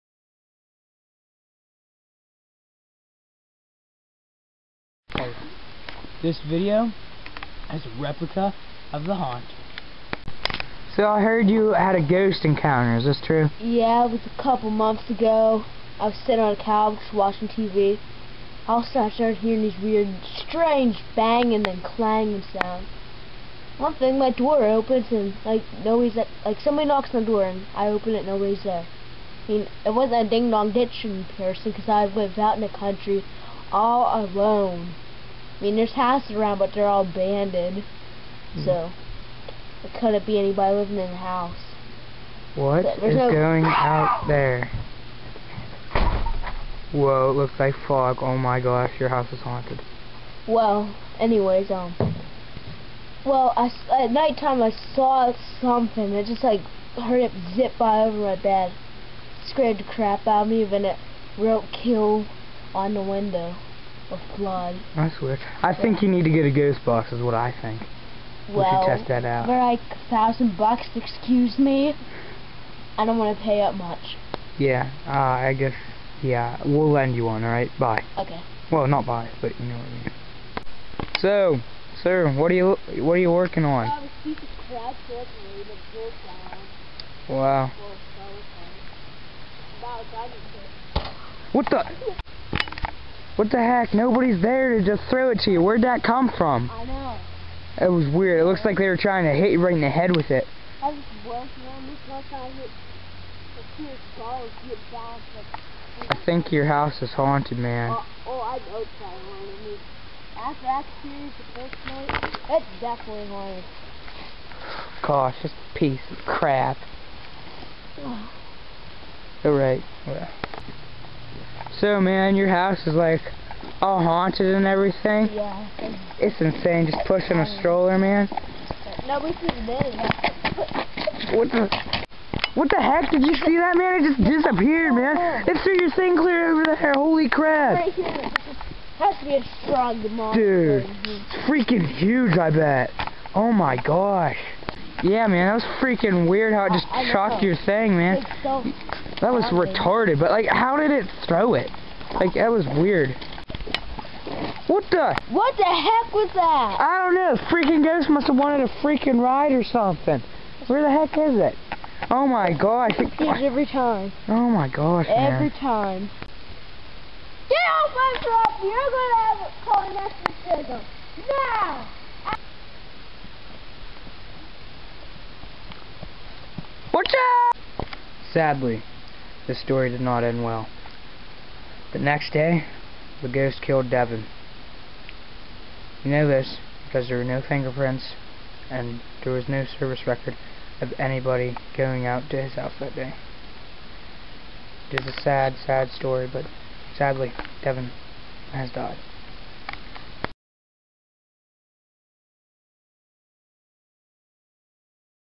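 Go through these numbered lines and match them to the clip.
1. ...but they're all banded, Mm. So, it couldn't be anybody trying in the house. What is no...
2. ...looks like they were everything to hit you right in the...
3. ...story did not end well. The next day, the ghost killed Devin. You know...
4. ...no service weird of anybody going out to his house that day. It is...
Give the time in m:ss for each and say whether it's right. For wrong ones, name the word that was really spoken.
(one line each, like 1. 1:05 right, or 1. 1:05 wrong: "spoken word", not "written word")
1. 0:36 wrong: "living", not "trying"
2. 1:38 wrong: "trying", not "everything"
3. 2:59 right
4. 3:09 wrong: "record", not "weird".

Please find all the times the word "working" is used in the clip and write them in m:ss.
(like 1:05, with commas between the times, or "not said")
1:23, 1:41.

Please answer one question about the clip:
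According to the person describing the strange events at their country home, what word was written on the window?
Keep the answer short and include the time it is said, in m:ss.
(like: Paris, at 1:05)
kill, at 1:01.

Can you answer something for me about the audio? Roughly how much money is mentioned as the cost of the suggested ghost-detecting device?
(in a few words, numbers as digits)
1000 bucks.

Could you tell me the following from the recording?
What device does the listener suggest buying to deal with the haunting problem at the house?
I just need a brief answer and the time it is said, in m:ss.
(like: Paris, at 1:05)
ghost box, at 1:06.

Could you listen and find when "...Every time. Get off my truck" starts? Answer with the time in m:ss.
2:45.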